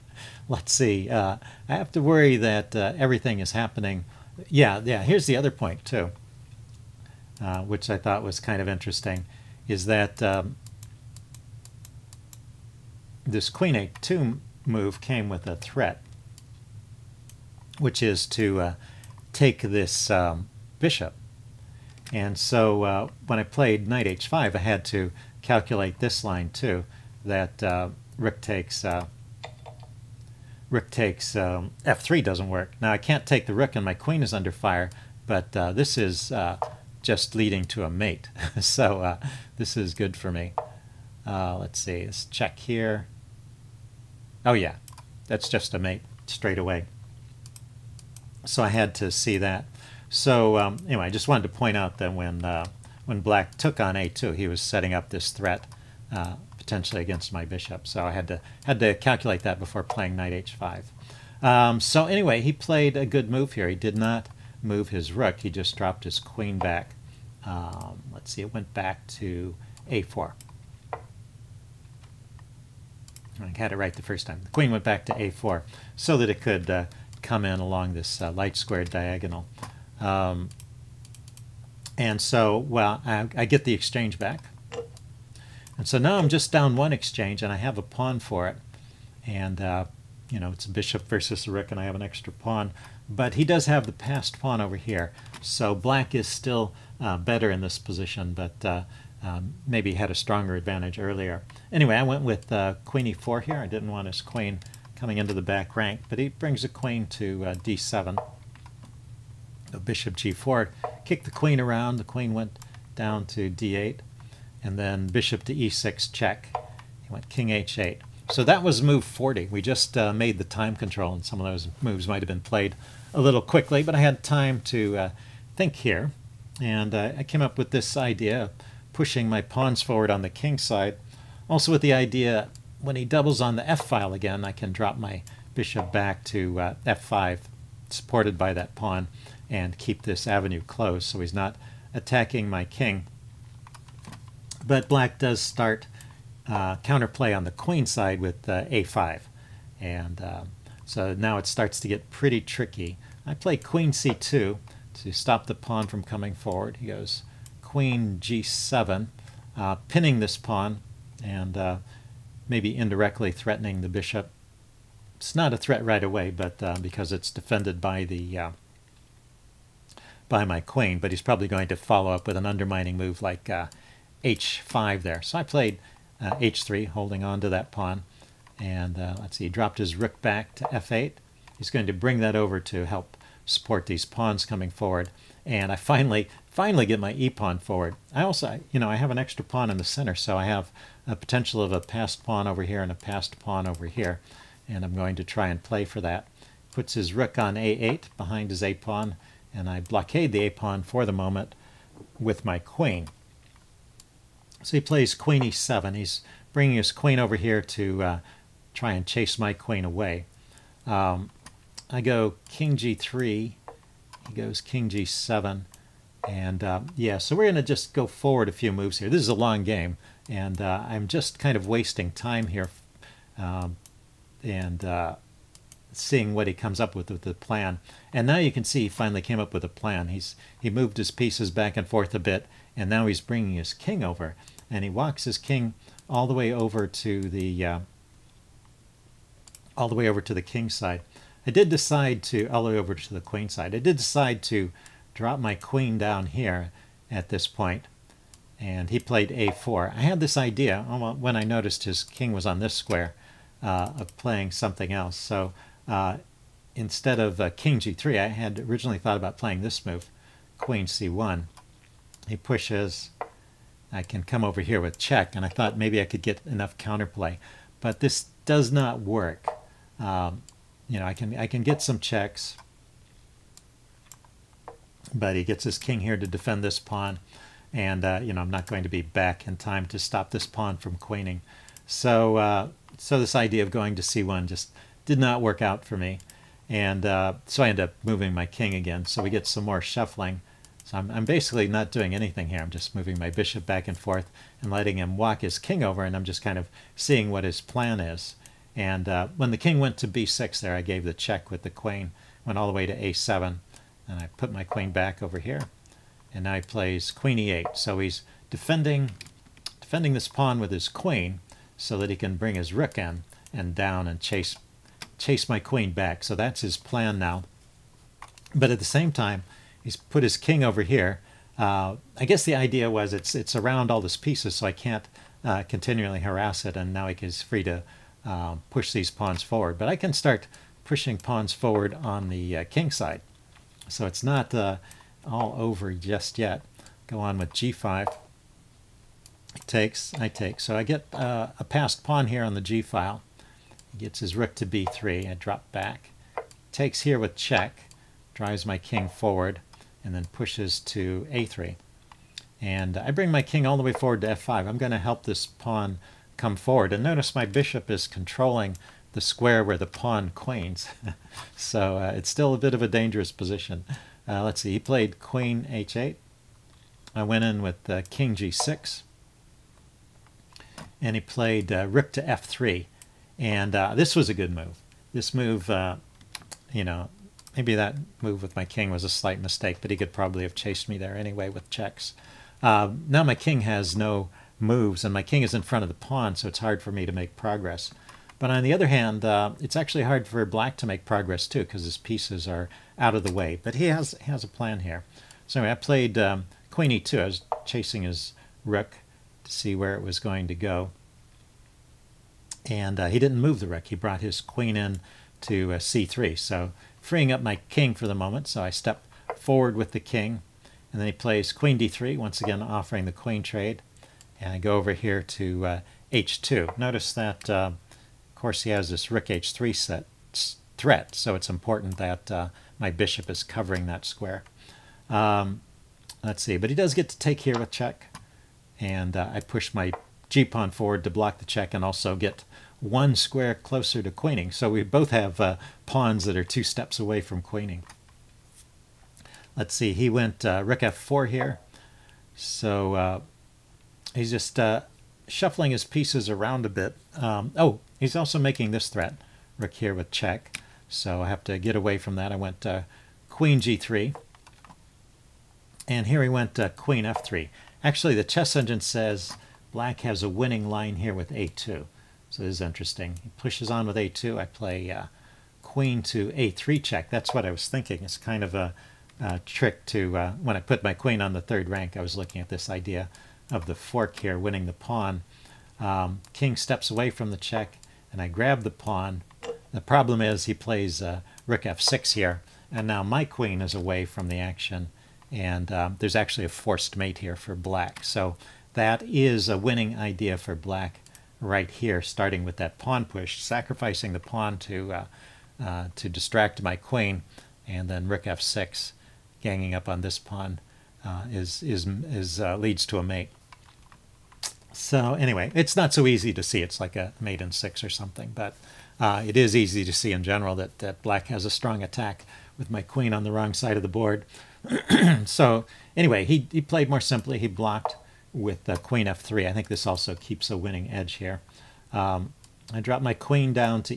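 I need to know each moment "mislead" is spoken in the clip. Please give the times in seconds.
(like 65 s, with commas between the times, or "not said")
not said.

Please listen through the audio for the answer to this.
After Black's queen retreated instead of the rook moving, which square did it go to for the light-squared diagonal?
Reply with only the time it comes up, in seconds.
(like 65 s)
74 s.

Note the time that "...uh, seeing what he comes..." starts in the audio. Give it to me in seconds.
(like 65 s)
224 s.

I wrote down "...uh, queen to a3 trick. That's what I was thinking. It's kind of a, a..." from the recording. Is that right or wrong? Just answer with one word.
wrong.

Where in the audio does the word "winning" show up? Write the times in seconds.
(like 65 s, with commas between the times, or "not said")
460 s, 474 s, 489 s, 520 s.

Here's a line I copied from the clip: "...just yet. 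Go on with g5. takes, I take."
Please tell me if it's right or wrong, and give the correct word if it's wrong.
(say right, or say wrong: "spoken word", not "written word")
right.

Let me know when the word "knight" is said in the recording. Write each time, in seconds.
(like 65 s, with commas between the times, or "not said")
23 s, 60 s.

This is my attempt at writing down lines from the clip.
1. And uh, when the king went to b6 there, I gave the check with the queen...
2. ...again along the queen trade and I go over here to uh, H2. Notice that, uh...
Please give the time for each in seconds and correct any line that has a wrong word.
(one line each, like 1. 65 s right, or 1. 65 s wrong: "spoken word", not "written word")
1. 298 s right
2. 412 s wrong: "offering", not "along".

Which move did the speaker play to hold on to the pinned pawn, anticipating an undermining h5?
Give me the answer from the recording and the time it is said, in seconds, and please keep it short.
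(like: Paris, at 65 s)
h3, at 175 s.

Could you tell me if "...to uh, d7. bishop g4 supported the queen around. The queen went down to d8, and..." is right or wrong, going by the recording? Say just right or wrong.
wrong.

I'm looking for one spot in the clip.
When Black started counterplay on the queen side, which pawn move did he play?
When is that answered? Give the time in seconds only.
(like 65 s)
148 s.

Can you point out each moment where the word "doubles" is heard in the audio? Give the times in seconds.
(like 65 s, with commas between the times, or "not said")
133 s.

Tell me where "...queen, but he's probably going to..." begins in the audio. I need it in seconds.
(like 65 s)
170 s.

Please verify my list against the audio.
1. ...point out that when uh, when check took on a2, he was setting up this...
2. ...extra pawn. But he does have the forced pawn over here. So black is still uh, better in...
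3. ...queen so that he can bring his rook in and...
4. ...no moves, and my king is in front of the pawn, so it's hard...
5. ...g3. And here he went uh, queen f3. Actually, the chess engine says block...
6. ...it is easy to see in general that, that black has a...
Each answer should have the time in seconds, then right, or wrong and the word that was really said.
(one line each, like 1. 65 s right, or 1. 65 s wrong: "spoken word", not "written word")
1. 51 s wrong: "black", not "check"
2. 92 s wrong: "passed", not "forced"
3. 310 s right
4. 383 s right
5. 453 s wrong: "black", not "block"
6. 509 s right.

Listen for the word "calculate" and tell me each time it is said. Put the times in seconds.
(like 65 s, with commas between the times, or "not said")
25 s, 58 s.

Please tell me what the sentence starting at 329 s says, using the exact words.
But I can start pushing pawns forward on the uh, king side.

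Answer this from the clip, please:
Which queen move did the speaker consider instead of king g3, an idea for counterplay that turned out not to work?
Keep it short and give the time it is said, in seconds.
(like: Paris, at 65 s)
queen c1, at 260 s.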